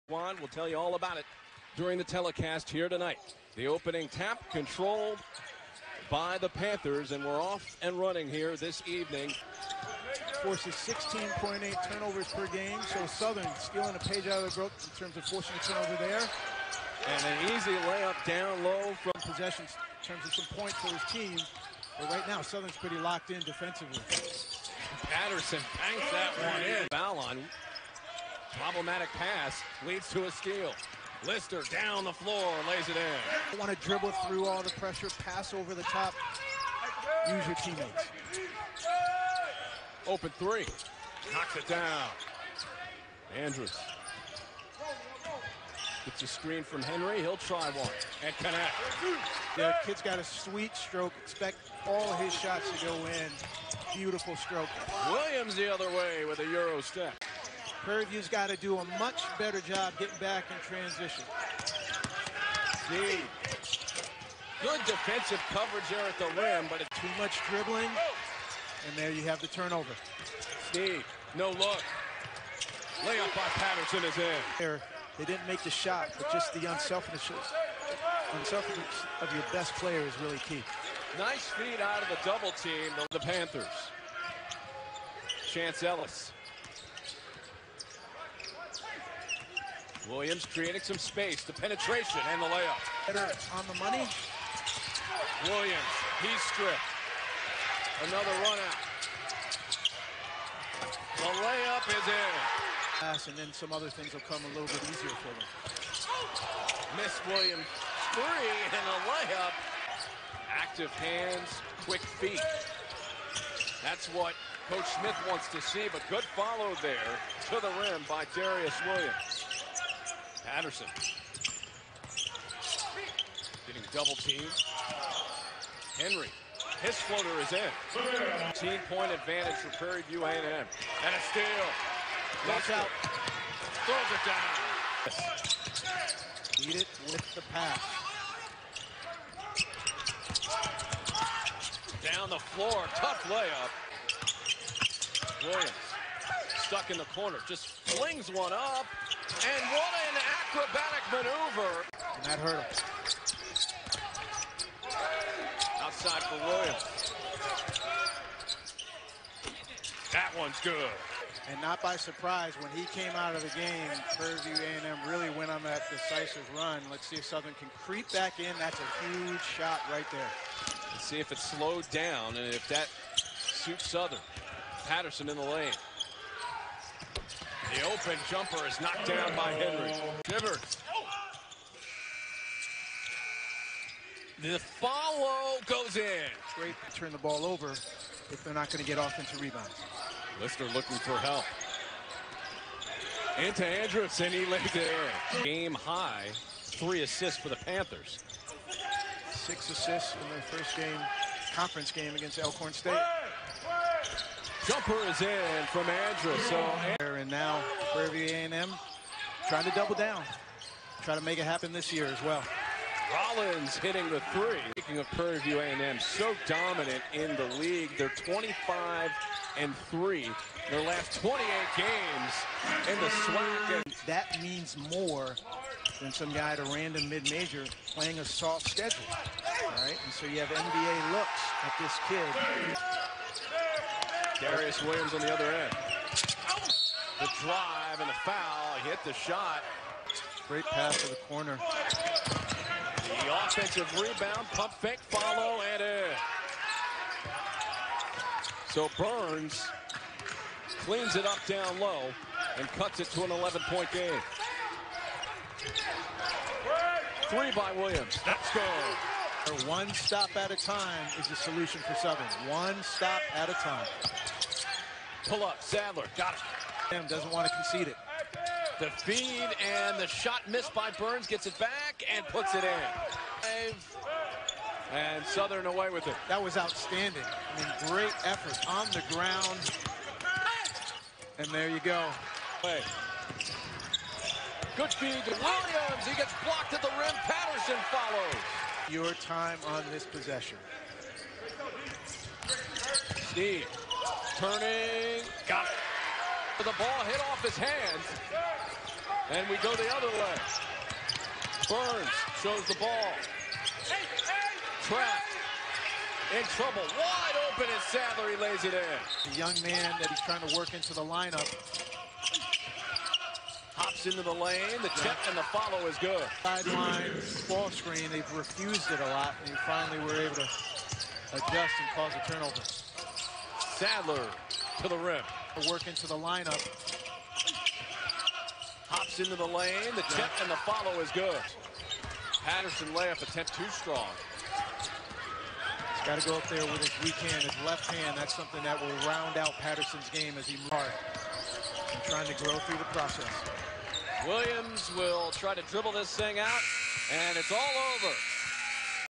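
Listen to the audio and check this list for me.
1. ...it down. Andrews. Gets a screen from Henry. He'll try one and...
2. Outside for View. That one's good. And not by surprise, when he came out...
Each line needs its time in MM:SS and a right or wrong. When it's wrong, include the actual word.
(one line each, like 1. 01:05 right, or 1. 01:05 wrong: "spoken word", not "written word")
1. 00:41 right
2. 02:35 wrong: "Williams", not "View".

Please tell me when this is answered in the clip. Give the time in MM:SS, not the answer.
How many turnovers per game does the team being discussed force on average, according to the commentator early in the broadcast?
00:10.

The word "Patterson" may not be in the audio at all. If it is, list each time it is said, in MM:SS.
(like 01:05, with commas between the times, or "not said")
00:25, 01:13, 02:00, 02:54, 04:47, 05:32, 05:39.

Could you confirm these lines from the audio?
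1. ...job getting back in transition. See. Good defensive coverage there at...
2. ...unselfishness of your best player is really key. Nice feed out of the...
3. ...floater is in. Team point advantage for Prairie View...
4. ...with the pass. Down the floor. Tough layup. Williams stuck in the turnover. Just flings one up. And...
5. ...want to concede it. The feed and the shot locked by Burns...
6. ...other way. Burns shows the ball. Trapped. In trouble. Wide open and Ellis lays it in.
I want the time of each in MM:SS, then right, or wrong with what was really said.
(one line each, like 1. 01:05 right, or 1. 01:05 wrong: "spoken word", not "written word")
1. 00:59 right
2. 01:18 right
3. 02:07 right
4. 02:17 wrong: "corner", not "turnover"
5. 04:27 wrong: "missed", not "locked"
6. 04:59 wrong: "Sadler", not "Ellis".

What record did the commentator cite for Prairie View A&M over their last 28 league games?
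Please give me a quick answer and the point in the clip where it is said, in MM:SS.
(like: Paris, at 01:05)
25 and 3, at 03:38.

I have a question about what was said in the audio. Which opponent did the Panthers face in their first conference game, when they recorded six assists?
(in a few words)
Alcorn State.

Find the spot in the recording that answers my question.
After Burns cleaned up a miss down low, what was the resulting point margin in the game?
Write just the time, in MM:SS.
04:13.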